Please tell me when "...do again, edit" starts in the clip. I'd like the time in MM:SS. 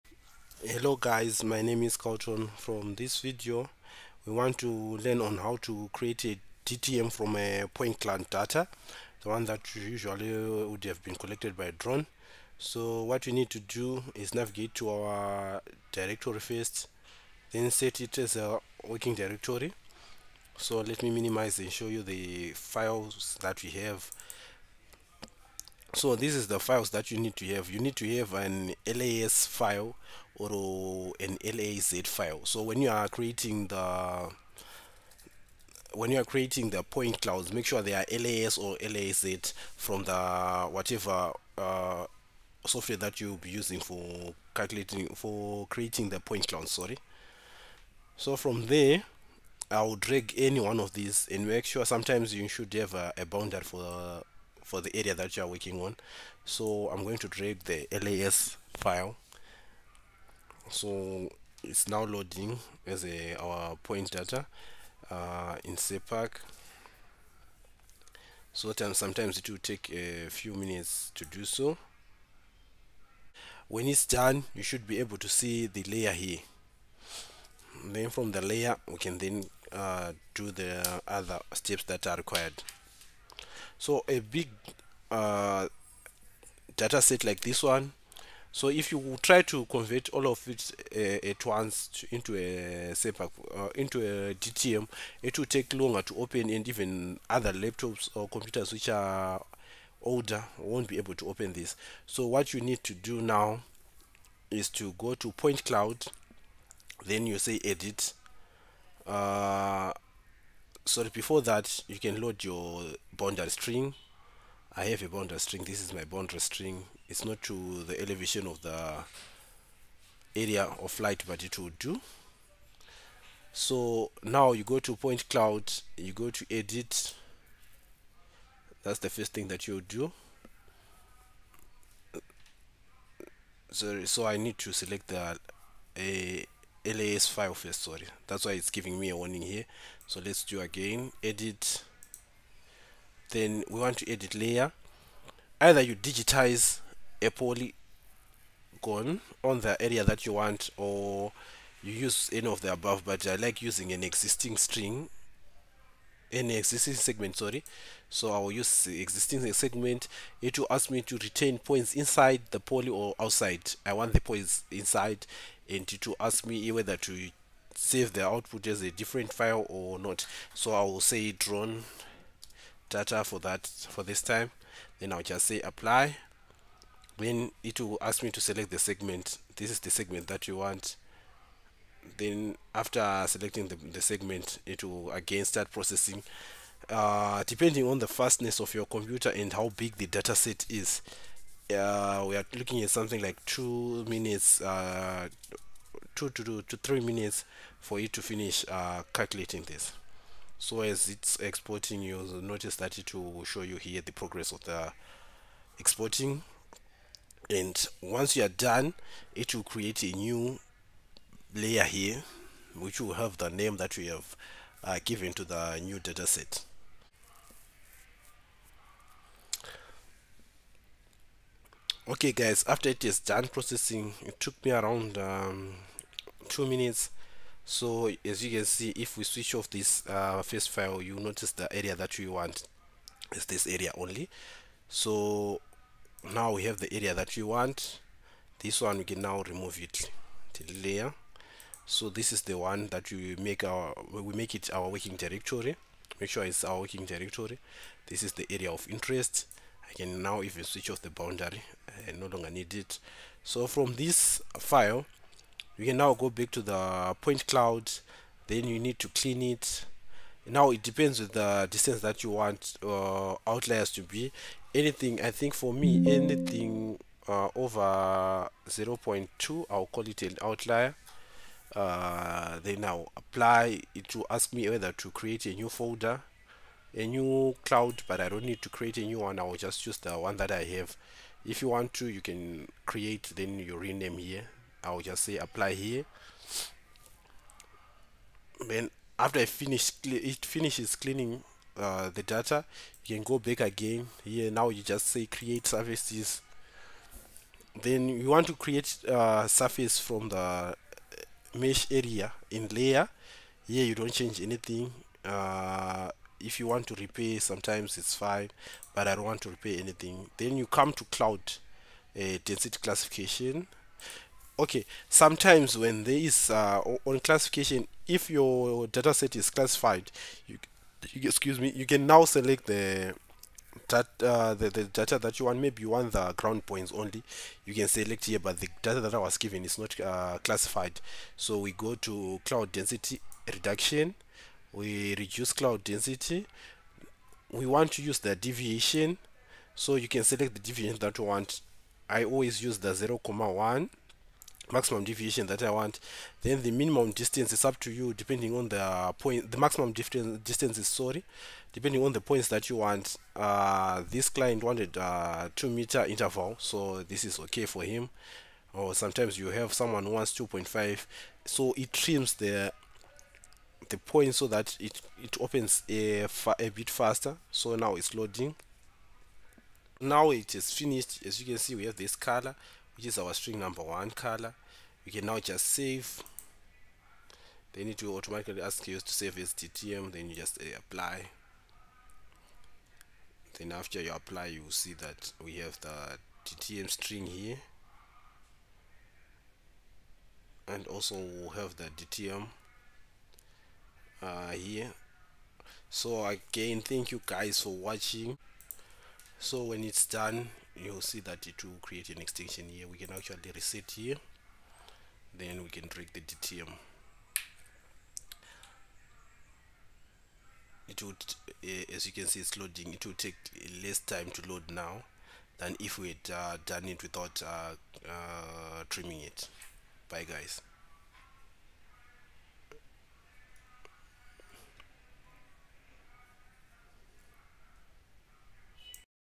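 02:20.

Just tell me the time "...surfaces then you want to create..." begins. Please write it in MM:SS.
04:55.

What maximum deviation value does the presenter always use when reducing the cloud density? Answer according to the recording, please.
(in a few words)
0.1.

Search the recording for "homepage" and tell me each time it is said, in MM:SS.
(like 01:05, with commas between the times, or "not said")
not said.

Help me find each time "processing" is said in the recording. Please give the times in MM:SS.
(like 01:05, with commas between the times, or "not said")
03:05, 03:43.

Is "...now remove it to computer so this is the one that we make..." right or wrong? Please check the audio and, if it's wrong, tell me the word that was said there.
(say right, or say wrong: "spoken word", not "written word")
wrong: "layer", not "computer".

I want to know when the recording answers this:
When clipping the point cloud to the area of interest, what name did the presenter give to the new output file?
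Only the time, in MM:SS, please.
02:51.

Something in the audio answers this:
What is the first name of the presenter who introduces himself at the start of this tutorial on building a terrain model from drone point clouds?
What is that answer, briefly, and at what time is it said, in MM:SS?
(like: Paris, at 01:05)
Carlton, at 00:01.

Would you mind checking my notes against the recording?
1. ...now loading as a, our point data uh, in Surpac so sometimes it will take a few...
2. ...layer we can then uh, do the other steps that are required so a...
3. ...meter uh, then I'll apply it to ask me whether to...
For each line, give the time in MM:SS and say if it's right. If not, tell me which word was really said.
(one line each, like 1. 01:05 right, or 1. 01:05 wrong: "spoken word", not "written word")
1. 01:01 right
2. 01:18 right
3. 04:30 wrong: "outlier", not "meter".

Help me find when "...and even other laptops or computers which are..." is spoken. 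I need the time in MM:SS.
01:36.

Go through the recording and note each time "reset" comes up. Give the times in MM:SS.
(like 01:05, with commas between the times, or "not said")
06:43.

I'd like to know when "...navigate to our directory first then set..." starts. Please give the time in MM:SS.
00:14.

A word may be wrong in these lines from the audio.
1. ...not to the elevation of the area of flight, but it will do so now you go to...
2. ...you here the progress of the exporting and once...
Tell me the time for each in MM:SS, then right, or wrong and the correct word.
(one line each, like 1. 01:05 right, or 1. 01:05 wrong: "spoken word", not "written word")
1. 01:57 right
2. 03:23 right.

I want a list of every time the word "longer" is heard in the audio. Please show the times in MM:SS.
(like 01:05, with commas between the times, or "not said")
01:35, 04:12.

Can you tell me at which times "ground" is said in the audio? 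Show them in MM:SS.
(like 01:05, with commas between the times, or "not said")
05:26.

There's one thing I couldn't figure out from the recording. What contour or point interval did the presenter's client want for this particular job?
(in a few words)
2 meter.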